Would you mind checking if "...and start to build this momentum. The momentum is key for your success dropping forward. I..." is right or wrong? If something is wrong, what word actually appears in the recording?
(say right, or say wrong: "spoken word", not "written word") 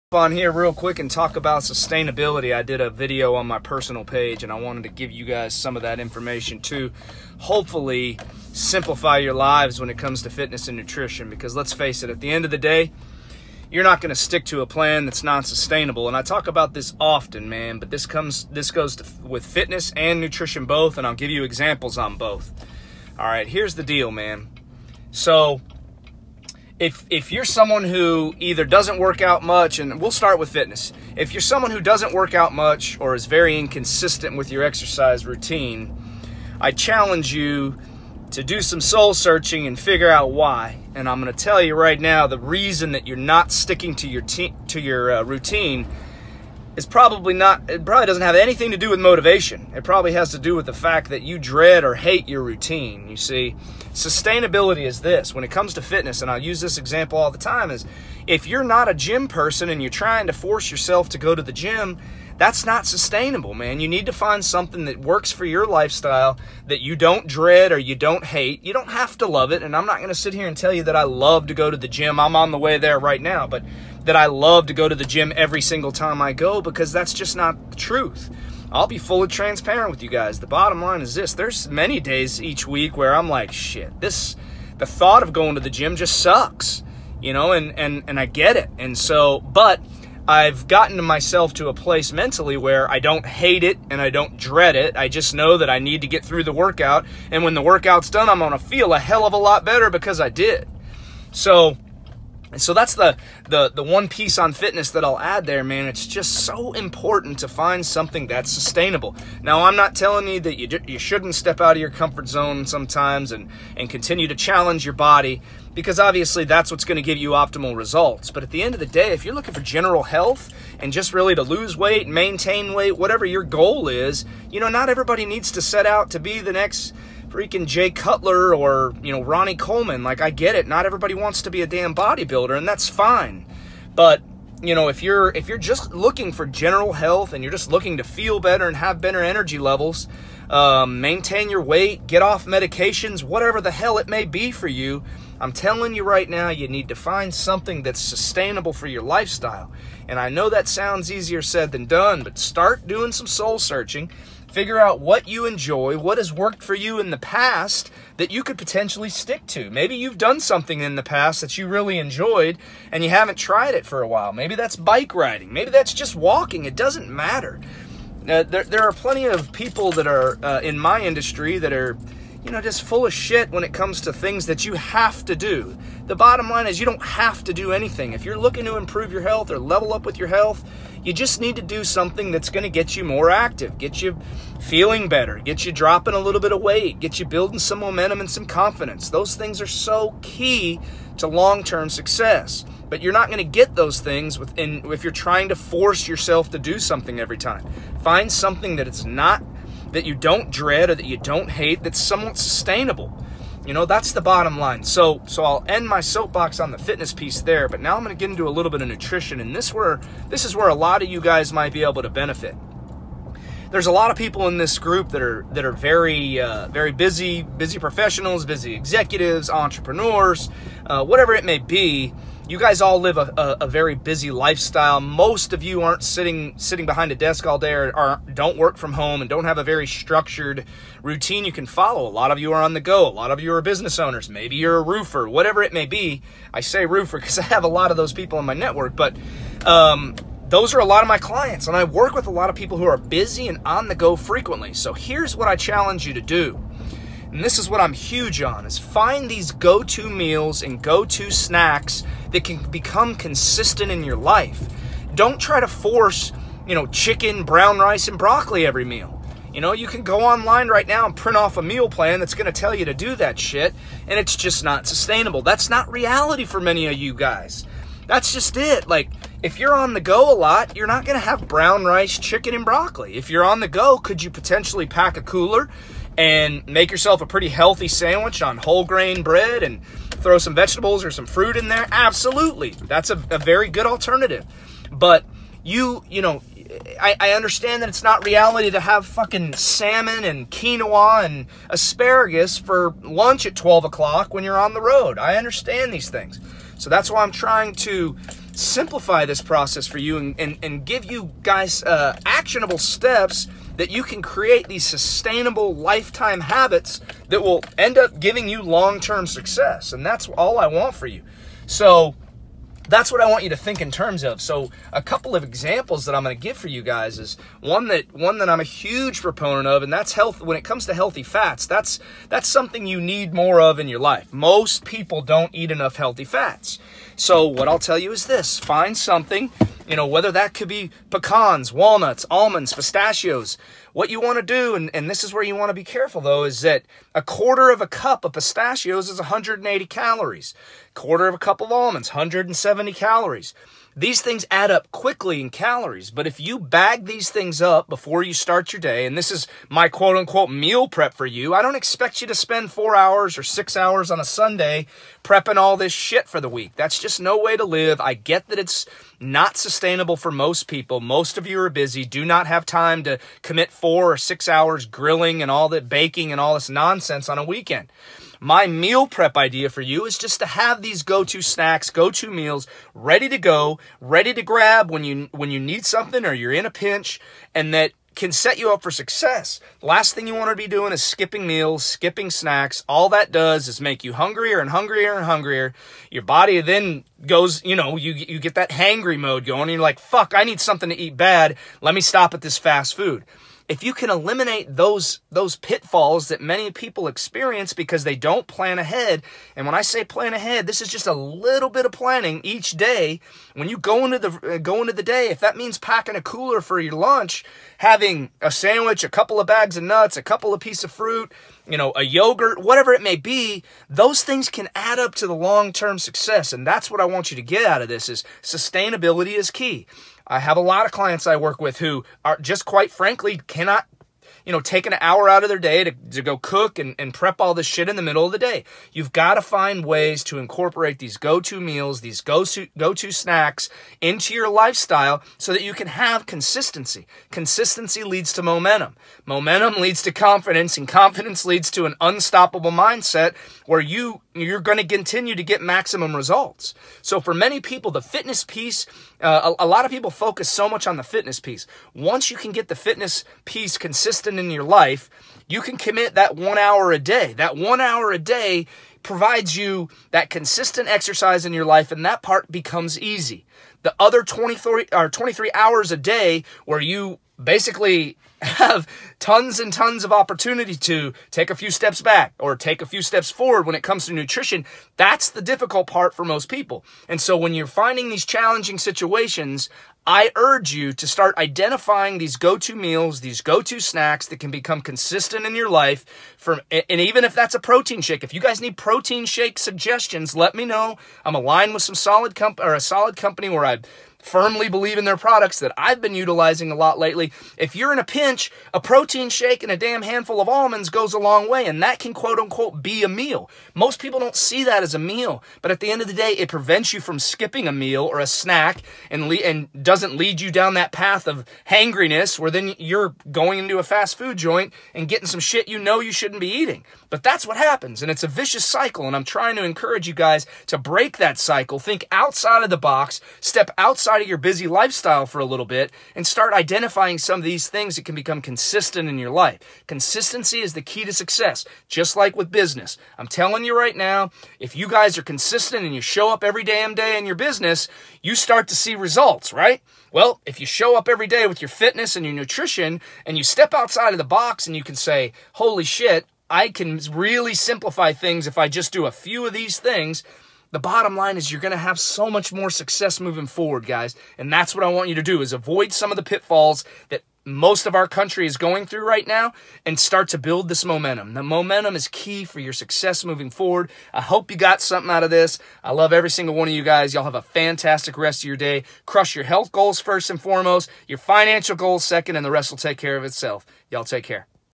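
wrong: "moving", not "dropping".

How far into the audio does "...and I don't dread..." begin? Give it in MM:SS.
01:33.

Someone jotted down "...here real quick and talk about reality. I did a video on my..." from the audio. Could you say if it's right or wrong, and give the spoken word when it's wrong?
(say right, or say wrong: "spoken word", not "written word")
wrong: "sustainability", not "reality".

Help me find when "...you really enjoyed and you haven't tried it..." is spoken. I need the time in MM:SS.
02:41.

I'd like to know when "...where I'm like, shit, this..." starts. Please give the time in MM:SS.
01:22.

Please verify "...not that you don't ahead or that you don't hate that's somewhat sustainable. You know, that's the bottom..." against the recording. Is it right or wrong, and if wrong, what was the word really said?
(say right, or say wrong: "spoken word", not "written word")
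wrong: "dread", not "ahead".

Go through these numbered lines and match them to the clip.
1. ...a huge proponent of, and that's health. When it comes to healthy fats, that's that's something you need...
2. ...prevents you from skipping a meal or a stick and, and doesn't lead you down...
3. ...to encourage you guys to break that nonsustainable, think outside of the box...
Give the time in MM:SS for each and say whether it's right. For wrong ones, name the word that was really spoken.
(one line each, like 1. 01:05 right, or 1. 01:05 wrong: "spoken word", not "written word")
1. 05:18 right
2. 08:26 wrong: "snack", not "stick"
3. 08:39 wrong: "cycle", not "nonsustainable".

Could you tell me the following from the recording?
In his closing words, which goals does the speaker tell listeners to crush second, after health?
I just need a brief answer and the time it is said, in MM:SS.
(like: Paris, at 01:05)
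financial goals, at 09:31.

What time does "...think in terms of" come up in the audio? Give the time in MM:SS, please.
05:13.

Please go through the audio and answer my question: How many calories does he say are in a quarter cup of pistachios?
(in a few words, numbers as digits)
180.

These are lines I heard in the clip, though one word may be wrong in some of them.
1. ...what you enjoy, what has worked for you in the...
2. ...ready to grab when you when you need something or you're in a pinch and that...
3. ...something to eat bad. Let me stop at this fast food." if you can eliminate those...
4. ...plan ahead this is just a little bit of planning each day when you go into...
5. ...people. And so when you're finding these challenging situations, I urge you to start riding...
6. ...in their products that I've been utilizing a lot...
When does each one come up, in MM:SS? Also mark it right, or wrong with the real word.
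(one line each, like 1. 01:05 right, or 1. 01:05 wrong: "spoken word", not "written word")
1. 02:34 right
2. 06:14 right
3. 06:30 right
4. 06:40 right
5. 07:56 wrong: "identifying", not "riding"
6. 08:14 right.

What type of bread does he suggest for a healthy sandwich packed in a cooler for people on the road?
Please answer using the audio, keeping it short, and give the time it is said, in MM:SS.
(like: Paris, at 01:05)
whole grain, at 04:38.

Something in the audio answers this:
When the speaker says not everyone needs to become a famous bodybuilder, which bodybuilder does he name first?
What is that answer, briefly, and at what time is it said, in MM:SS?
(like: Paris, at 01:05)
Jay Cutler, at 02:07.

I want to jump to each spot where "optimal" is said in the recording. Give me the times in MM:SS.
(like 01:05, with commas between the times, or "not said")
01:57.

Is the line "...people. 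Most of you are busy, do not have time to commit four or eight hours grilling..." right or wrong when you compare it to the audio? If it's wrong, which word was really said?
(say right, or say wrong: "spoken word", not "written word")
wrong: "six", not "eight".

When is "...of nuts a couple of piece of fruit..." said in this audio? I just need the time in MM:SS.
06:49.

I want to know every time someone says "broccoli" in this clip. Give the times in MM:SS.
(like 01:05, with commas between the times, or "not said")
04:18, 04:32.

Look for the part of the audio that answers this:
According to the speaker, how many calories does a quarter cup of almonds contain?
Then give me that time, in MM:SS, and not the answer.
05:42.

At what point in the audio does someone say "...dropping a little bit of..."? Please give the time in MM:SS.
03:05.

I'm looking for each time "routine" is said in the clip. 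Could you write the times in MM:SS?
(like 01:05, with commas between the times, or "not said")
00:35, 00:45, 00:52, 03:51.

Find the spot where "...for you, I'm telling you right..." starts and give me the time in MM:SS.
02:24.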